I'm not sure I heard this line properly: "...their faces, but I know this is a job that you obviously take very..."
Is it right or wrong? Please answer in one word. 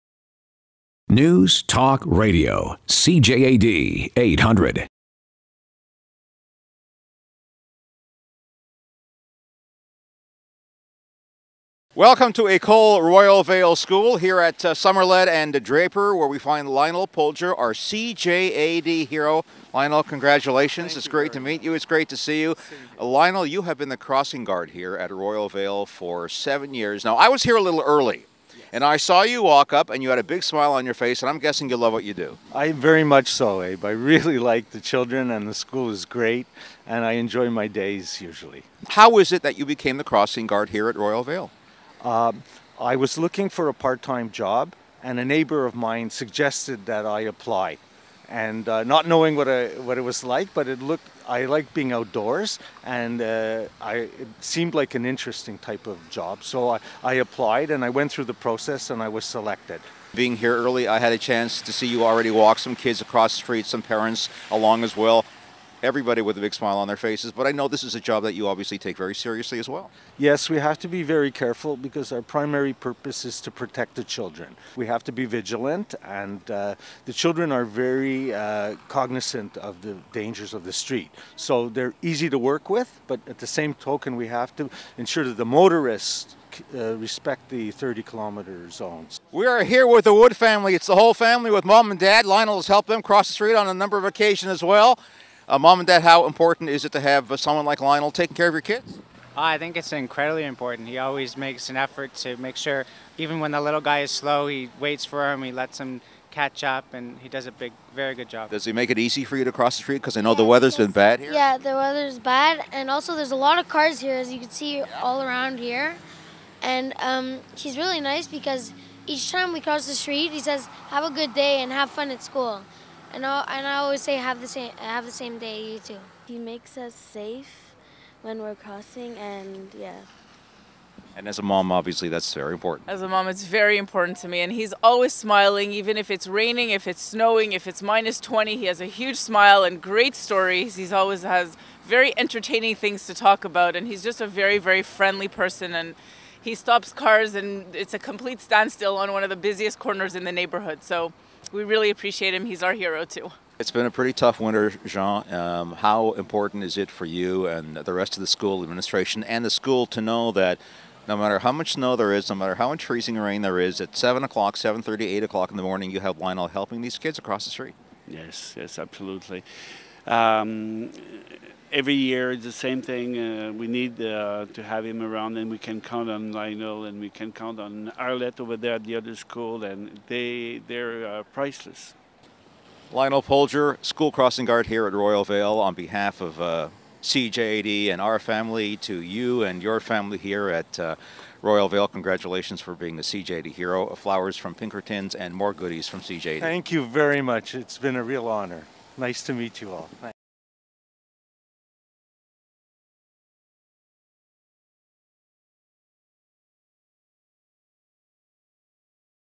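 right.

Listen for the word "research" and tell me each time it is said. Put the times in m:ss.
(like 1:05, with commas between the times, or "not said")
not said.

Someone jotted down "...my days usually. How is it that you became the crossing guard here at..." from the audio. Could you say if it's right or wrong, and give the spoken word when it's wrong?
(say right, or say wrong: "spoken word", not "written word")
right.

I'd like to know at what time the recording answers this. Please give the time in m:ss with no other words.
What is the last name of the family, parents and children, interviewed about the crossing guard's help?
1:30.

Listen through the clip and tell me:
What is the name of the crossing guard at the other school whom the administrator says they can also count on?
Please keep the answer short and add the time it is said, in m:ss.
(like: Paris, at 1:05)
Arlette, at 2:57.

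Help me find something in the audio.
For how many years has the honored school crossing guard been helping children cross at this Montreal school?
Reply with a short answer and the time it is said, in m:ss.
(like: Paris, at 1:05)
7, at 0:26.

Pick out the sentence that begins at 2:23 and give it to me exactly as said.
And he's just a very, very friendly person.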